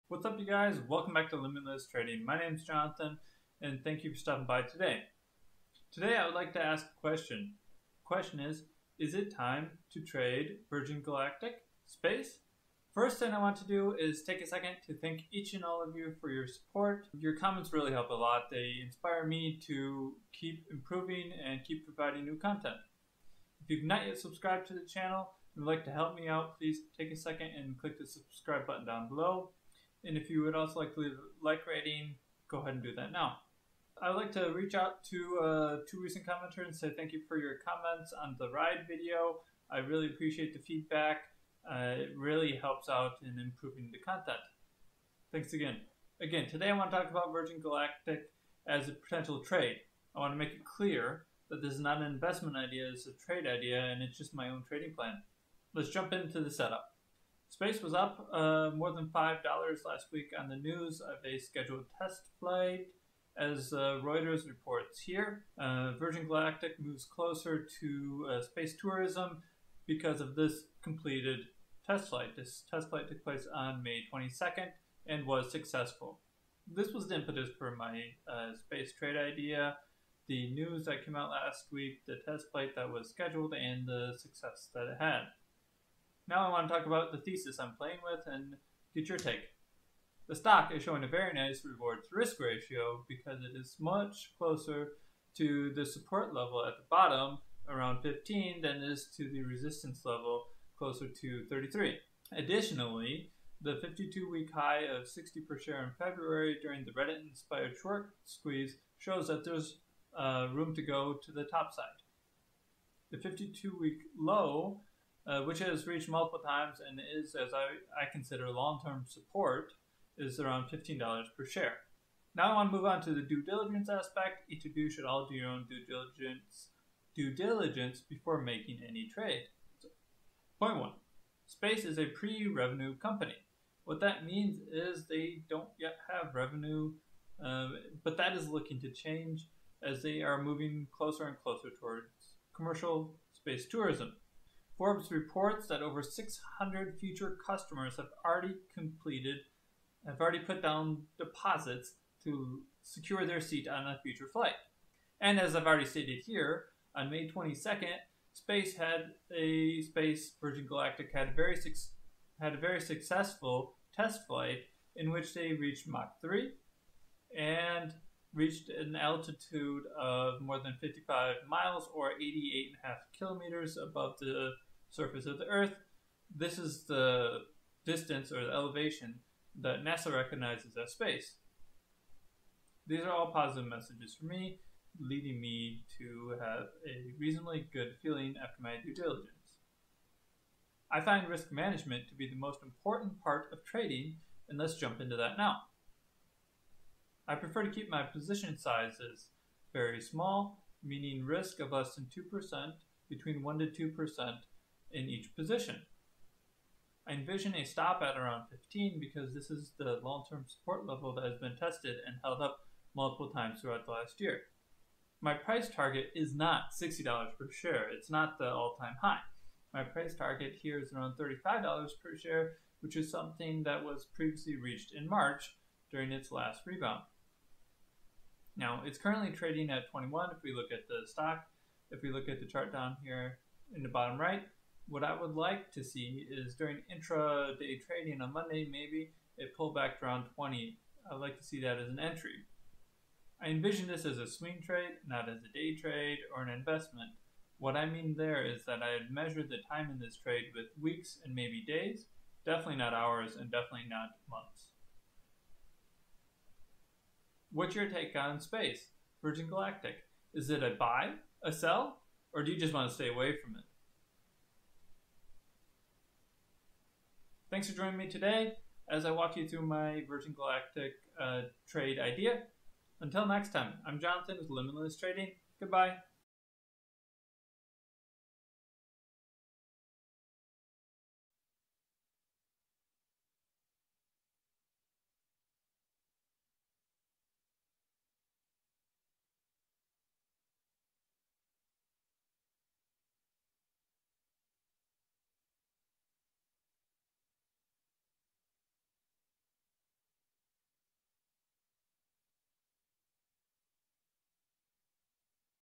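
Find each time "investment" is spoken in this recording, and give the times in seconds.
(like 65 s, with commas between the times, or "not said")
52 s, 246 s.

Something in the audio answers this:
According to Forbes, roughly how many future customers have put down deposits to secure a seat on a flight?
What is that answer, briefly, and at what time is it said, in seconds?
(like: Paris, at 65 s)
over 600, at 145 s.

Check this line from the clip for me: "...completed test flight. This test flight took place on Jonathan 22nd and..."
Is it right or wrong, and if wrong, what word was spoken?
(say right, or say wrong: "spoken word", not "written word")
wrong: "May", not "Jonathan".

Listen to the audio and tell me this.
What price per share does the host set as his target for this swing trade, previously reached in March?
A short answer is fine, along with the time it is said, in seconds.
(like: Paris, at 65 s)
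$35, at 221 s.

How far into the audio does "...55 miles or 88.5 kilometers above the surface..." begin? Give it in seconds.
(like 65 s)
170 s.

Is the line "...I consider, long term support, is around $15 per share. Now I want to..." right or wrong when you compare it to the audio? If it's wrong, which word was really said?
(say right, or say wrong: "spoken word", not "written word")
right.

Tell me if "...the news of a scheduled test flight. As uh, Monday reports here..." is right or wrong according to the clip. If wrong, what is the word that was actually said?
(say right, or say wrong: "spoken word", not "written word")
wrong: "Reuters", not "Monday".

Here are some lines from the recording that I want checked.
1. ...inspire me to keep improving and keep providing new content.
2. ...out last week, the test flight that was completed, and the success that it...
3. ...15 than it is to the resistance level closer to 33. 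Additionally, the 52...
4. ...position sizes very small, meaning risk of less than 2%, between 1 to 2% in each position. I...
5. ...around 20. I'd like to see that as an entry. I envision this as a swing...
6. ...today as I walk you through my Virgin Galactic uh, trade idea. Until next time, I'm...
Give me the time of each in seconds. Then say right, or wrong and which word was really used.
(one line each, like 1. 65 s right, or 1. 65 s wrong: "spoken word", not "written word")
1. 18 s right
2. 81 s wrong: "scheduled", not "completed"
3. 98 s right
4. 198 s right
5. 240 s right
6. 268 s right.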